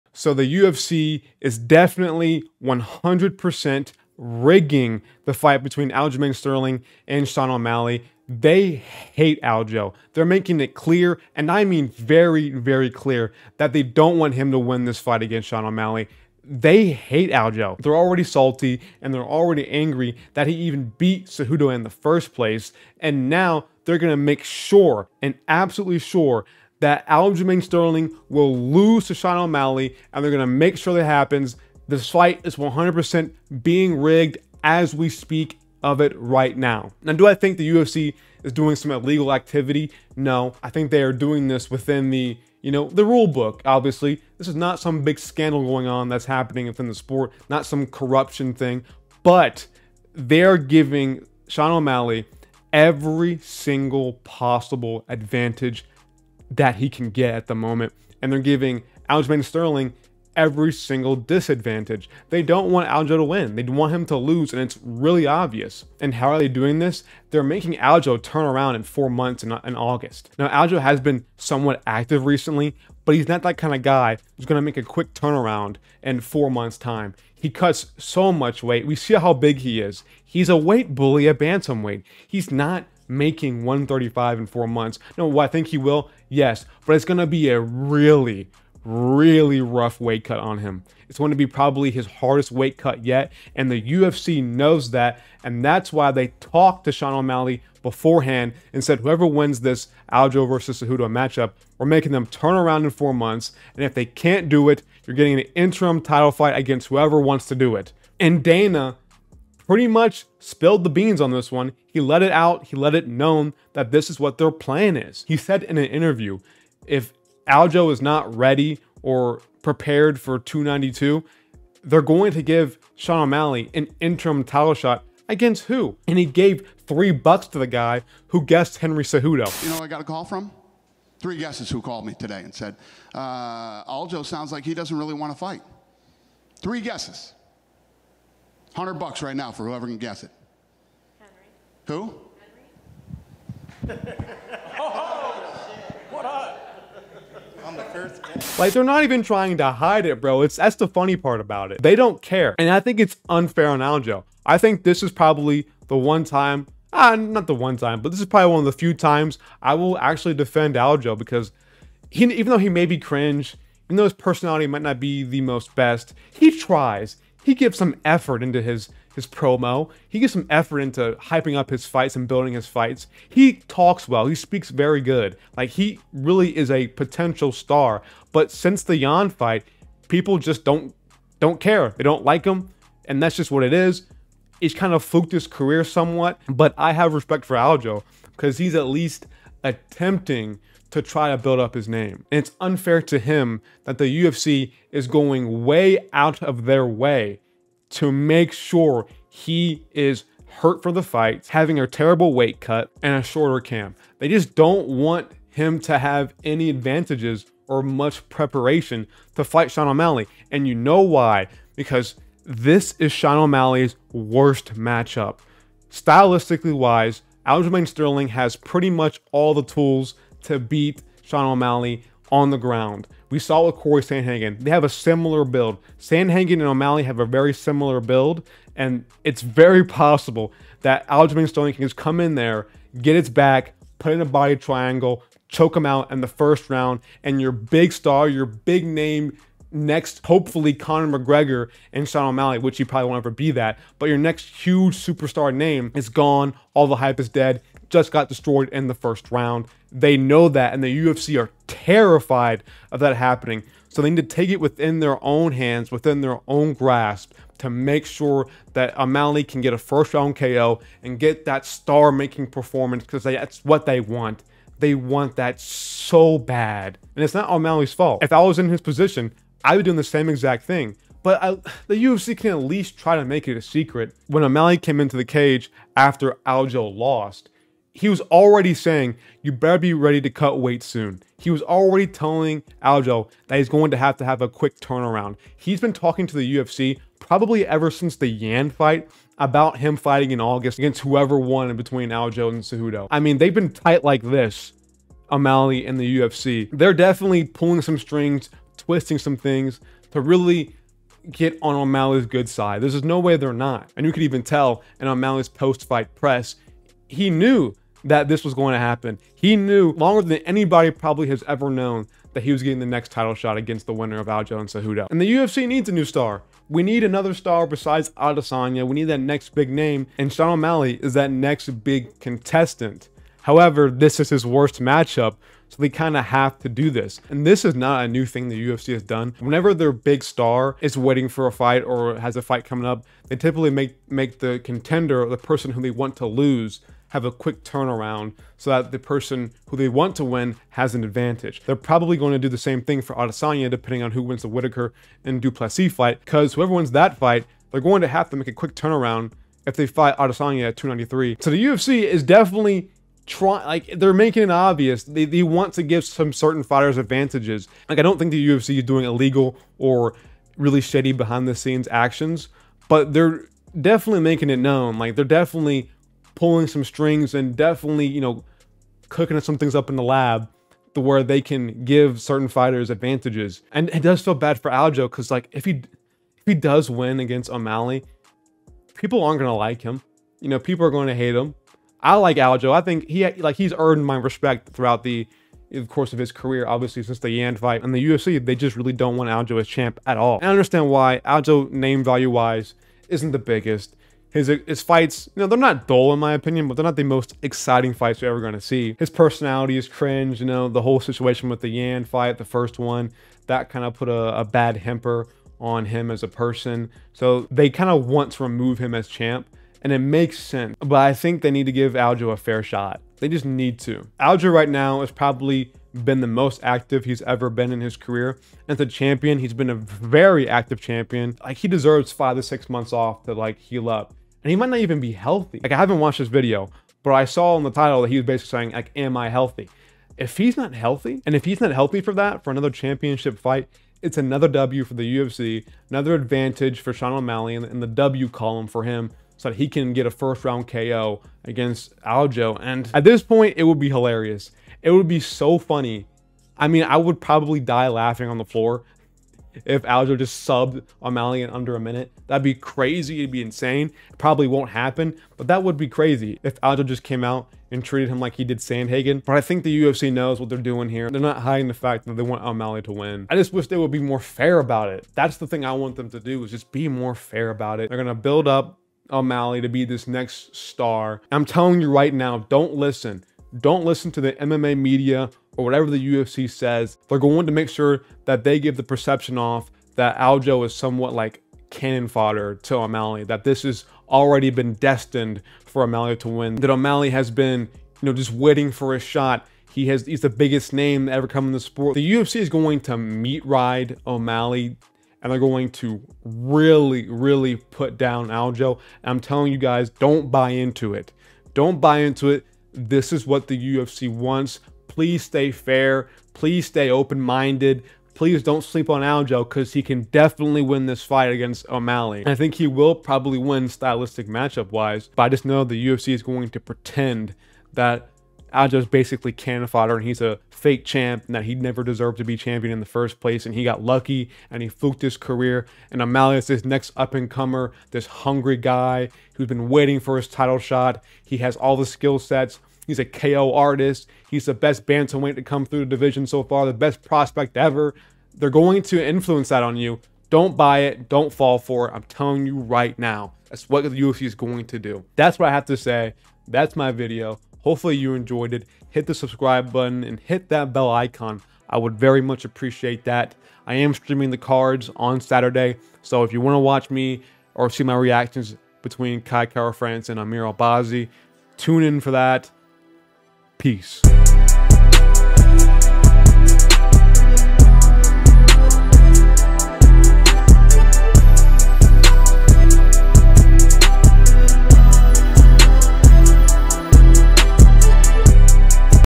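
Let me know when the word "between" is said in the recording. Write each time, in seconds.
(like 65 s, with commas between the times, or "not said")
5 s, 291 s, 558 s.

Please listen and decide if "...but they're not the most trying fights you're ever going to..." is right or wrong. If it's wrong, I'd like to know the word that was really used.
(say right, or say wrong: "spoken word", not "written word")
wrong: "exciting", not "trying".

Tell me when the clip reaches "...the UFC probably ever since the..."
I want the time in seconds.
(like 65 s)
286 s.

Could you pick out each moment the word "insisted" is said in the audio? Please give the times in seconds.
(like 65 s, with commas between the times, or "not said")
not said.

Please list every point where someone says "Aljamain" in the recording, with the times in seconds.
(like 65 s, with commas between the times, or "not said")
5 s, 27 s, 59 s, 217 s, 231 s.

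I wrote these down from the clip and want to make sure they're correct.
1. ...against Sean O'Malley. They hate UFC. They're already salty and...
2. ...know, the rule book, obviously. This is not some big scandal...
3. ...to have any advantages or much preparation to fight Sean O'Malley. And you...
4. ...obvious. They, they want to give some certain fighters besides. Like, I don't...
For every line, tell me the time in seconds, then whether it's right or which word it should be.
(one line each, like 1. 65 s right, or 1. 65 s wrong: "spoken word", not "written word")
1. 15 s wrong: "Aljo", not "UFC"
2. 42 s right
3. 205 s right
4. 354 s wrong: "advantages", not "besides".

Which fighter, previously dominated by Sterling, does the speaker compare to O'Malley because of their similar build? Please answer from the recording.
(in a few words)
Cory Sandhagen.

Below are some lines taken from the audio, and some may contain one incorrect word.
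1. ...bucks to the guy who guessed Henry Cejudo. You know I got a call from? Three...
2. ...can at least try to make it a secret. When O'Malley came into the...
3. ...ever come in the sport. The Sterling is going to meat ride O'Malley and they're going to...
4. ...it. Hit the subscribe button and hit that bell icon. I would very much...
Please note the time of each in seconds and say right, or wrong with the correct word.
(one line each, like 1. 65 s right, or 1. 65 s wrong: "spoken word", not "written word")
1. 127 s right
2. 272 s right
3. 491 s wrong: "UFC", not "Sterling"
4. 548 s right.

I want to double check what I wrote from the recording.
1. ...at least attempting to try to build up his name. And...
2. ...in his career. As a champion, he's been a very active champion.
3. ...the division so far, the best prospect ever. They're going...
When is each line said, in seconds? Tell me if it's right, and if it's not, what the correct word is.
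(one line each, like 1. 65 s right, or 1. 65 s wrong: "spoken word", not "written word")
1. 188 s right
2. 417 s right
3. 535 s right.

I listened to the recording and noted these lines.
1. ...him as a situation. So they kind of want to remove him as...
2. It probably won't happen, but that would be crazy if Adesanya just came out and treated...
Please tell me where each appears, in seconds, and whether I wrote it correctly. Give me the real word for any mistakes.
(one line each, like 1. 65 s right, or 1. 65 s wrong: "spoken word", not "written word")
1. 405 s wrong: "person", not "situation"
2. 454 s wrong: "Aljo", not "Adesanya".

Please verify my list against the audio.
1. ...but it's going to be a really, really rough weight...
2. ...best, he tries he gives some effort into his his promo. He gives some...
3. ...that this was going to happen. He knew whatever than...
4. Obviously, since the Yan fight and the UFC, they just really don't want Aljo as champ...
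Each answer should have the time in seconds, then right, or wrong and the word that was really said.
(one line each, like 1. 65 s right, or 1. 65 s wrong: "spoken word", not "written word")
1. 86 s right
2. 165 s right
3. 308 s wrong: "longer", not "whatever"
4. 386 s right.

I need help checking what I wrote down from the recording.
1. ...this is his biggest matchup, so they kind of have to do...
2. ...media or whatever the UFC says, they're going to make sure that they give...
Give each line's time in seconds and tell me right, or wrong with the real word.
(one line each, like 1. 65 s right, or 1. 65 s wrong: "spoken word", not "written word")
1. 323 s wrong: "worst", not "biggest"
2. 474 s right.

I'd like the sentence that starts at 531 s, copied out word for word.
He has all the skill sets.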